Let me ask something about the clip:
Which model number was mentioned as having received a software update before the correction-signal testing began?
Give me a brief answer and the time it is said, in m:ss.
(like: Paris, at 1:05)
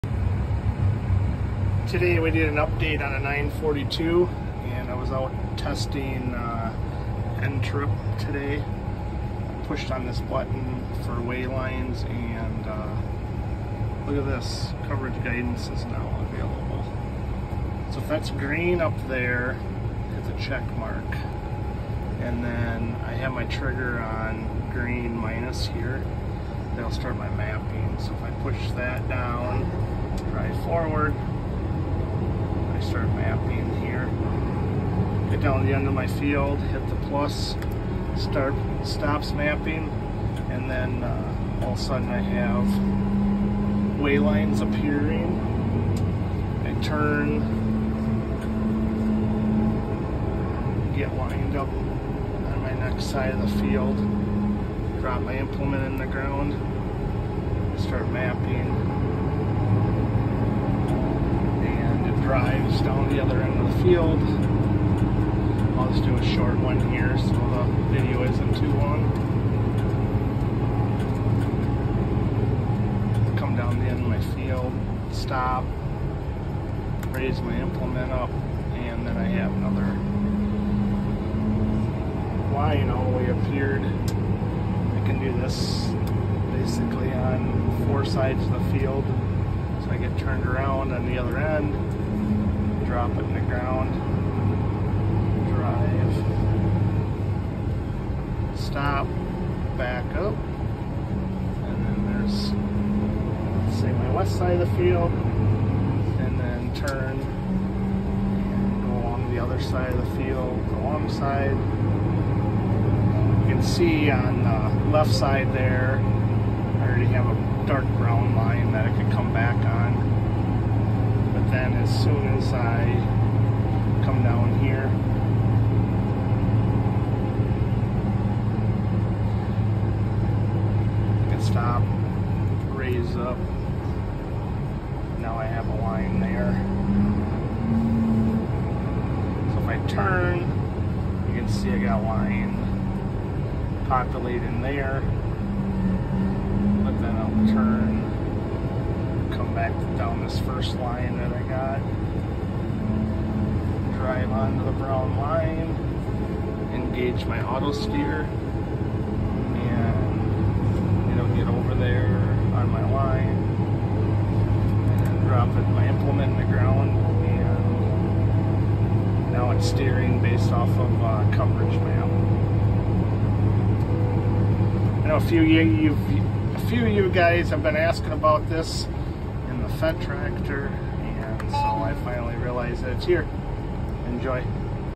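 942, at 0:03.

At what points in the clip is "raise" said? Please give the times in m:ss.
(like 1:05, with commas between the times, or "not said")
1:17, 2:12.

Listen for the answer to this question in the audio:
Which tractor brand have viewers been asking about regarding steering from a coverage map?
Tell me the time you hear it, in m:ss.
2:59.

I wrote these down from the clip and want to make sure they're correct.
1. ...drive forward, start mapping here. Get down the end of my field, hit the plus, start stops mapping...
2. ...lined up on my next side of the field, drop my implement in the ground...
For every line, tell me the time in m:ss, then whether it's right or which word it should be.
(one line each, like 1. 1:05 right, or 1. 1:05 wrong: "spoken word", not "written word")
1. 0:30 right
2. 0:51 right.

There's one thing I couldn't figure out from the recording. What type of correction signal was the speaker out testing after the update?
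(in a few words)
NTRIP.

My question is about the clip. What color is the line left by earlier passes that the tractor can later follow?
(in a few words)
dark brown.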